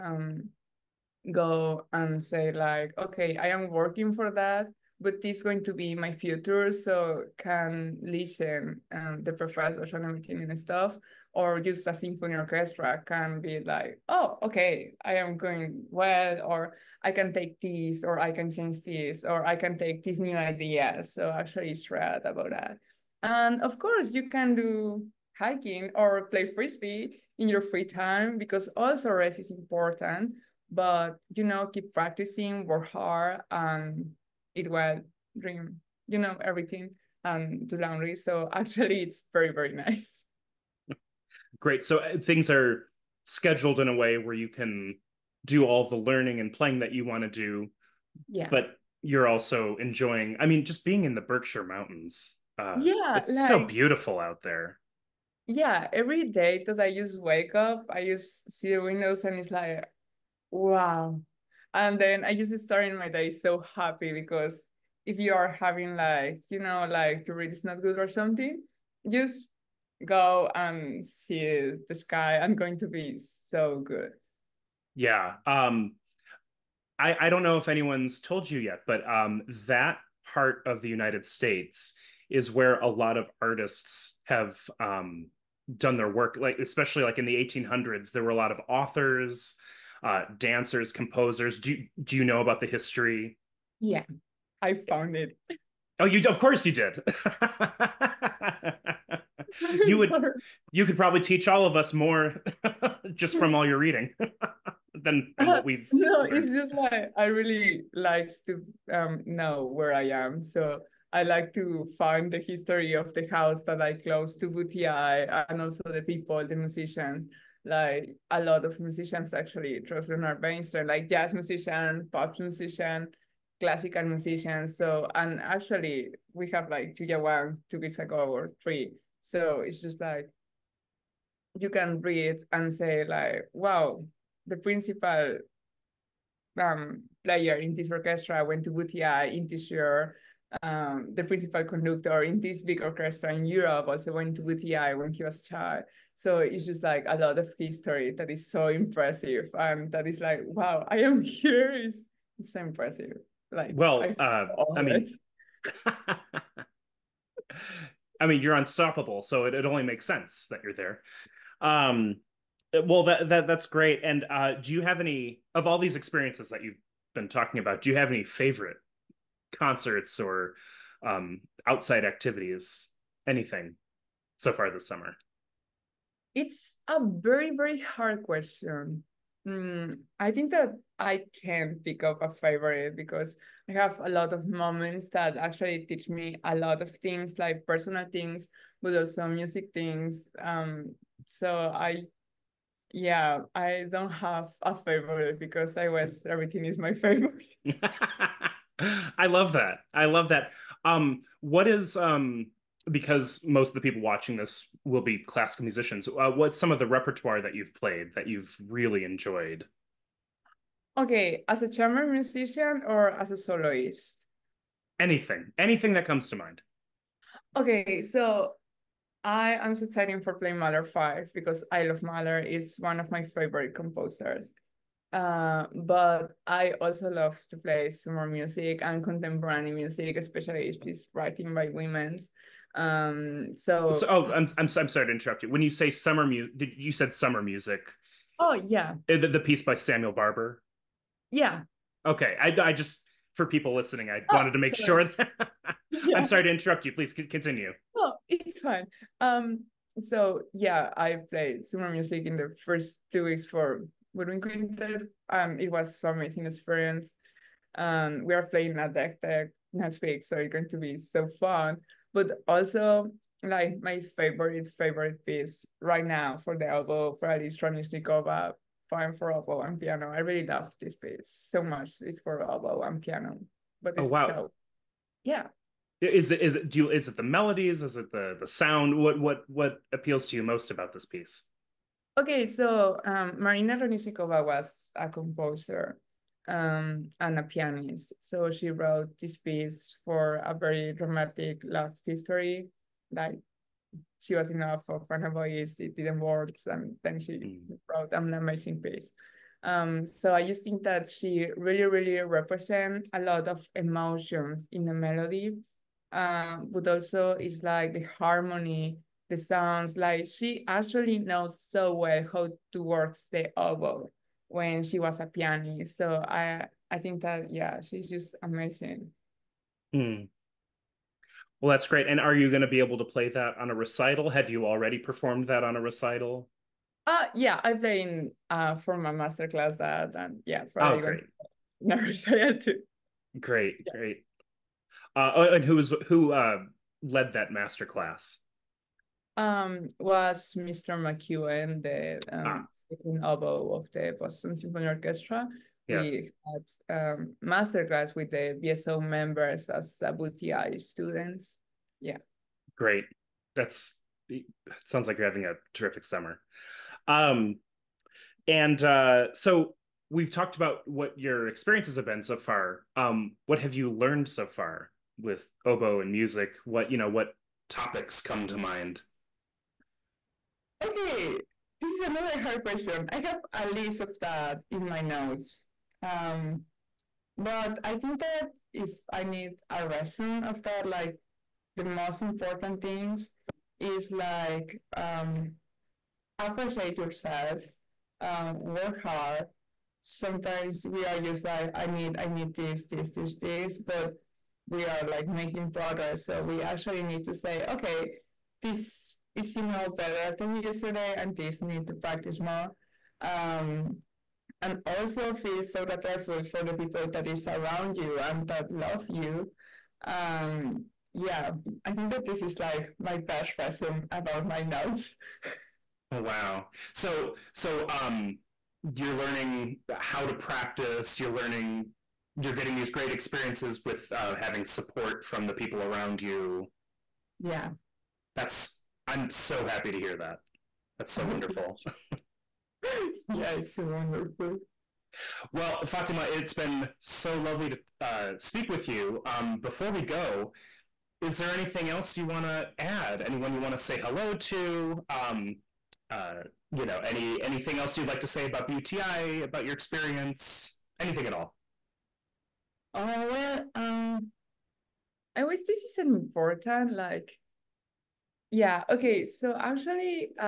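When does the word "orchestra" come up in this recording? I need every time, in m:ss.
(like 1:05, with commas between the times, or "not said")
0:12, 2:17, 2:22, 5:44.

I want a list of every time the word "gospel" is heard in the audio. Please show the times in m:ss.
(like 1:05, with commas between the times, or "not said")
not said.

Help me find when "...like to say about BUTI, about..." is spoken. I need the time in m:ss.
7:28.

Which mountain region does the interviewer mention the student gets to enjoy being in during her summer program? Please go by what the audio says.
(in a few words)
Berkshire Mountains.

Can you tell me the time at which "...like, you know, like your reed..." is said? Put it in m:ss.
1:05.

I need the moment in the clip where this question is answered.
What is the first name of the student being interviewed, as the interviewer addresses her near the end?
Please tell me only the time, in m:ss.
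7:15.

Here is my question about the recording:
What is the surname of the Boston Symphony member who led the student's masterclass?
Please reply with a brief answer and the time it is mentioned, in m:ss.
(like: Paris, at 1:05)
McEwen, at 5:40.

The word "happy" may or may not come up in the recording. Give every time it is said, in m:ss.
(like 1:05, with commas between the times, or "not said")
1:03, 7:09.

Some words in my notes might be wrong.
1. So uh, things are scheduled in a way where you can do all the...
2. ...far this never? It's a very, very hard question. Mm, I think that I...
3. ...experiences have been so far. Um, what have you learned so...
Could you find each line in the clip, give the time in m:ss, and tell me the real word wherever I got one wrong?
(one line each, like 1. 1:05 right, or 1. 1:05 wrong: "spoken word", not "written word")
1. 0:41 right
2. 2:54 wrong: "summer", not "never"
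3. 6:01 right.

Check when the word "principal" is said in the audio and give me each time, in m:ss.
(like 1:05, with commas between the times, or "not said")
2:14, 2:21.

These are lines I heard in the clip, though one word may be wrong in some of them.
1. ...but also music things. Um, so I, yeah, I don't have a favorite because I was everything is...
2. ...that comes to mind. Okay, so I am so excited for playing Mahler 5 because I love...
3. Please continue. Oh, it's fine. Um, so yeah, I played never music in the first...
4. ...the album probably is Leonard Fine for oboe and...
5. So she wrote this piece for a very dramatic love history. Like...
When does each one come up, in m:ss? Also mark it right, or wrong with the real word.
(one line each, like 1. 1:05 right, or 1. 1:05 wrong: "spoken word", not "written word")
1. 3:08 right
2. 3:35 right
3. 4:06 wrong: "summer", not "never"
4. 4:26 wrong: "Dranishnikova", not "Leonard"
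5. 4:48 right.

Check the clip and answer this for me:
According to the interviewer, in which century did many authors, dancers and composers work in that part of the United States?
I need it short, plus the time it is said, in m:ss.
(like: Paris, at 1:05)
1800s, at 1:27.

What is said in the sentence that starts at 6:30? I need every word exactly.
Sometimes we are just like, I need, I need this, this, this, this, but we are like making progress.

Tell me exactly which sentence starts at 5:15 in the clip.
So I I think that yeah, she's just amazing.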